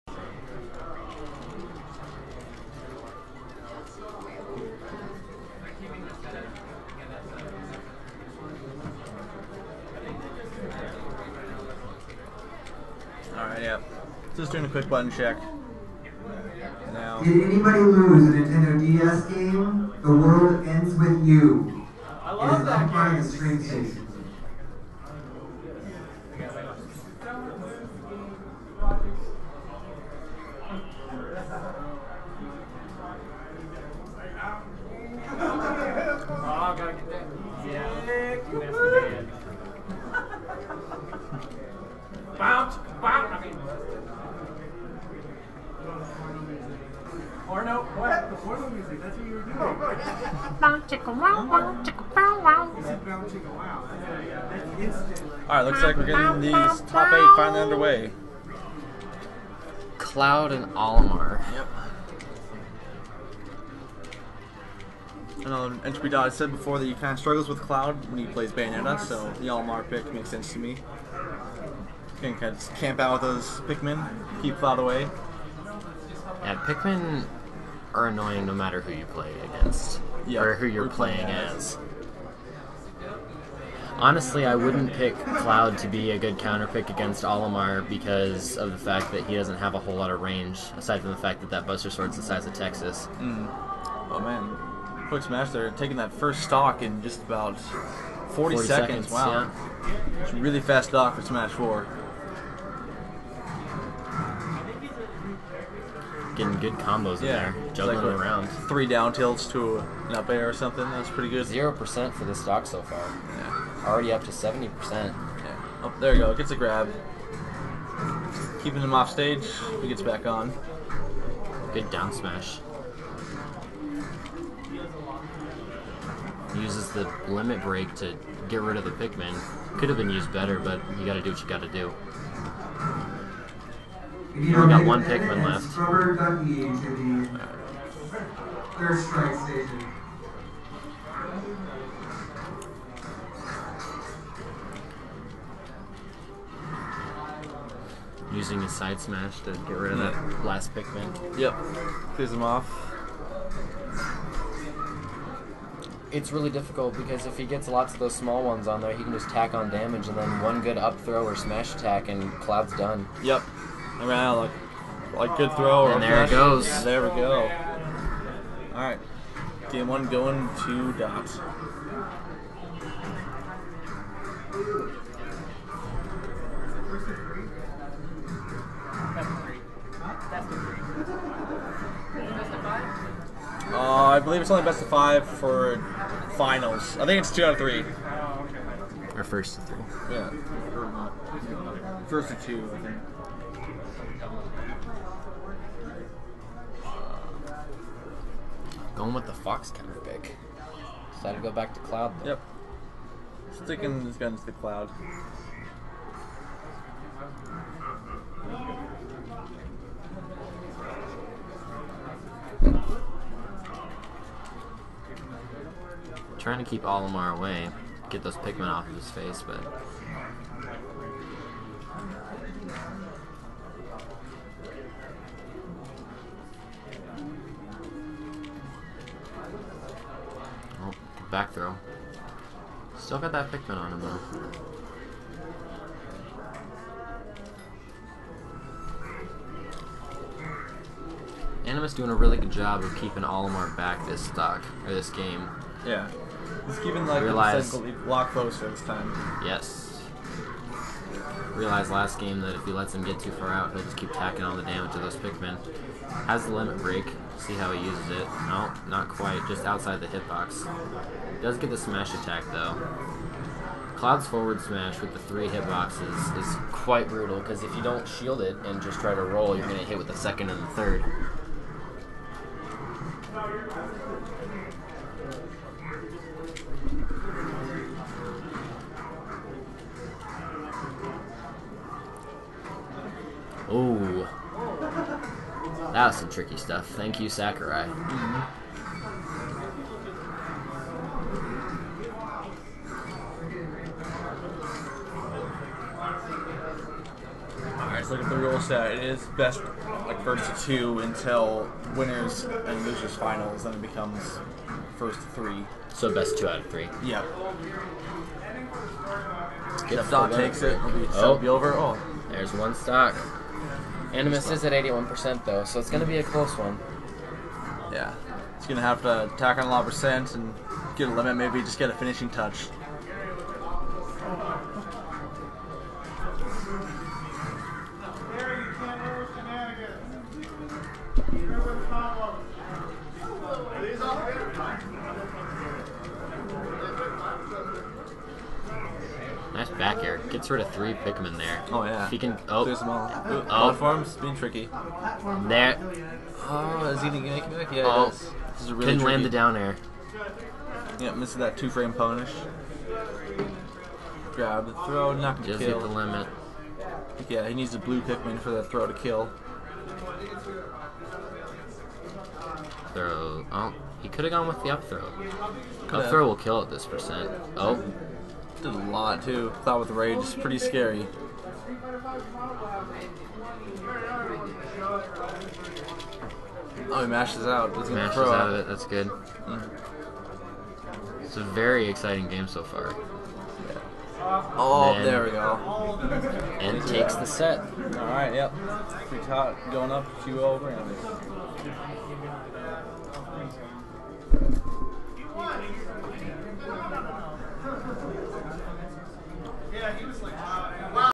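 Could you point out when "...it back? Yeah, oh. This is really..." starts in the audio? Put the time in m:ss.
5:47.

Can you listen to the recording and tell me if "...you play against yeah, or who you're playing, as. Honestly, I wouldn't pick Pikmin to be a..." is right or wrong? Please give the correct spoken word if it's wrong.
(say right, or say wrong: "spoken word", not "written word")
wrong: "Cloud", not "Pikmin".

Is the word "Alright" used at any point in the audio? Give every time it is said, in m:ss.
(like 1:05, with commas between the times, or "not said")
0:13, 0:55, 4:57.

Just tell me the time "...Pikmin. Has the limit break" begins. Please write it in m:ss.
4:15.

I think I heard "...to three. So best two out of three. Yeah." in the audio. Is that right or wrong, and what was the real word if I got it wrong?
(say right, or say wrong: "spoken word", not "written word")
right.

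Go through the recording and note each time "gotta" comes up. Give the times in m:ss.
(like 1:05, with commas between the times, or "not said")
0:36.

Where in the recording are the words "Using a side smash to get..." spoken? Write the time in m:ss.
2:28.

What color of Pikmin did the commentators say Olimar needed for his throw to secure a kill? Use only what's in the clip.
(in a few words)
Blue.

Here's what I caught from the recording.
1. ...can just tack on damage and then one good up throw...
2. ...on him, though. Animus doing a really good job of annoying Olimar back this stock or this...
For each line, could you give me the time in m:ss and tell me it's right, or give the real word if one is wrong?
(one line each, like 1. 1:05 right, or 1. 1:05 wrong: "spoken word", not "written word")
1. 2:39 right
2. 3:53 wrong: "keeping", not "annoying".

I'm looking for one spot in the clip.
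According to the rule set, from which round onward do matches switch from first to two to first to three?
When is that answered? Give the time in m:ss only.
5:01.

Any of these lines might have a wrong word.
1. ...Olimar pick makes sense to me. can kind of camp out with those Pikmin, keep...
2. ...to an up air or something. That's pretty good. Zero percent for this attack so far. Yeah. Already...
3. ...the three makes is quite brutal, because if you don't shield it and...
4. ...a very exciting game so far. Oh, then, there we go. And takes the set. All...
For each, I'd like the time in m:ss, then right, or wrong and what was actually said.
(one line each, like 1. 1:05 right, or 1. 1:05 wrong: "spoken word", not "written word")
1. 1:09 right
2. 1:49 wrong: "stock", not "attack"
3. 4:25 wrong: "hitboxes", not "makes"
4. 6:21 right.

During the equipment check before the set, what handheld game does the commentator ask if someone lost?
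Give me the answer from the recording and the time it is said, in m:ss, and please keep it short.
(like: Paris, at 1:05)
The World Ends with You, at 0:20.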